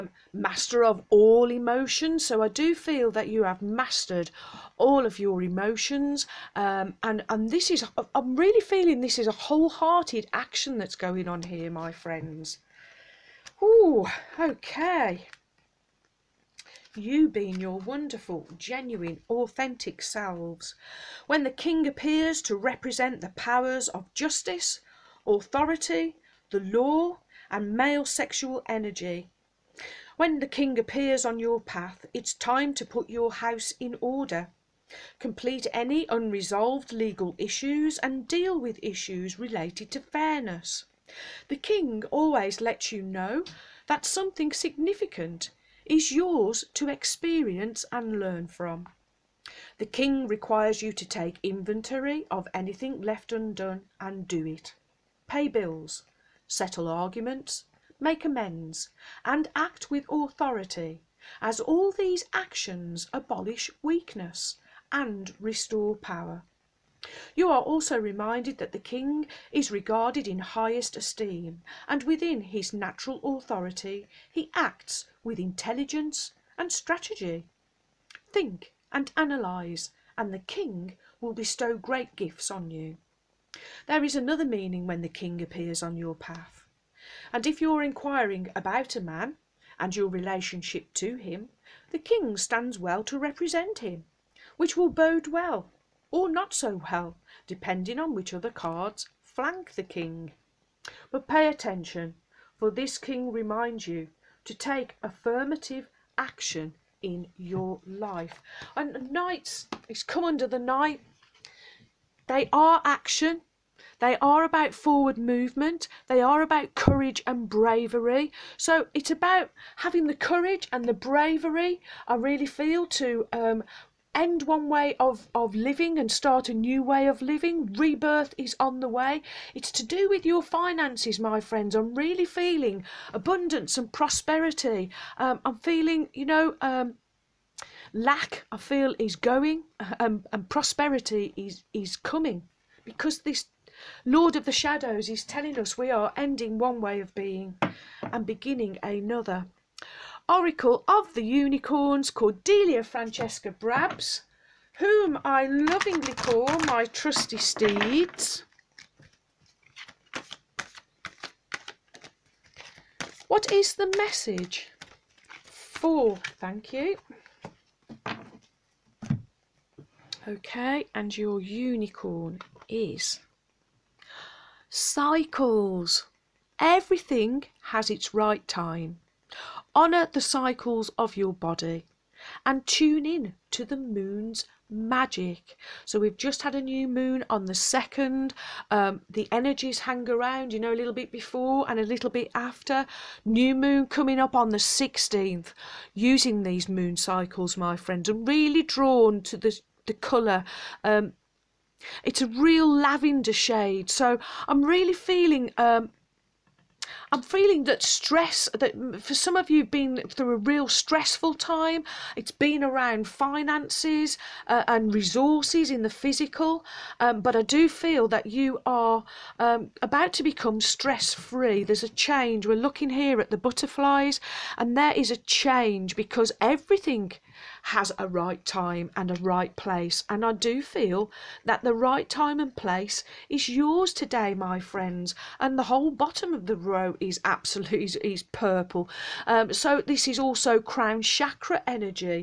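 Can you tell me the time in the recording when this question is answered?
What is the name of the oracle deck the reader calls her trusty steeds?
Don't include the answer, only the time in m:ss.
2:30.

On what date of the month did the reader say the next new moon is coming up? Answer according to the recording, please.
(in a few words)
16th.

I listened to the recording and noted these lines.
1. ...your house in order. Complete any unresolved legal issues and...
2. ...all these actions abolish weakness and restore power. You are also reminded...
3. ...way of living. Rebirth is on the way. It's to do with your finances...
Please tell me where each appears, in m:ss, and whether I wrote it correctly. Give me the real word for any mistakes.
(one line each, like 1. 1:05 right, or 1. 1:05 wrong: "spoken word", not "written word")
1. 0:33 right
2. 1:01 right
3. 2:06 right.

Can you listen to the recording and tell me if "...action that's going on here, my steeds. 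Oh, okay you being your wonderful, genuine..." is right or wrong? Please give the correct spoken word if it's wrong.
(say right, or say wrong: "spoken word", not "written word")
wrong: "friends", not "steeds".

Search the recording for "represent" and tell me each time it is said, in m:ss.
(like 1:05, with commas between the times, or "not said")
0:22, 1:33.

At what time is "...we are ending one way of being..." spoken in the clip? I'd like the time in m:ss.
2:25.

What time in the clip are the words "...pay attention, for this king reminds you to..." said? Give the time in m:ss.
1:41.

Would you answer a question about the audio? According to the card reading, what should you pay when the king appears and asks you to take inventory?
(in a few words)
Bills.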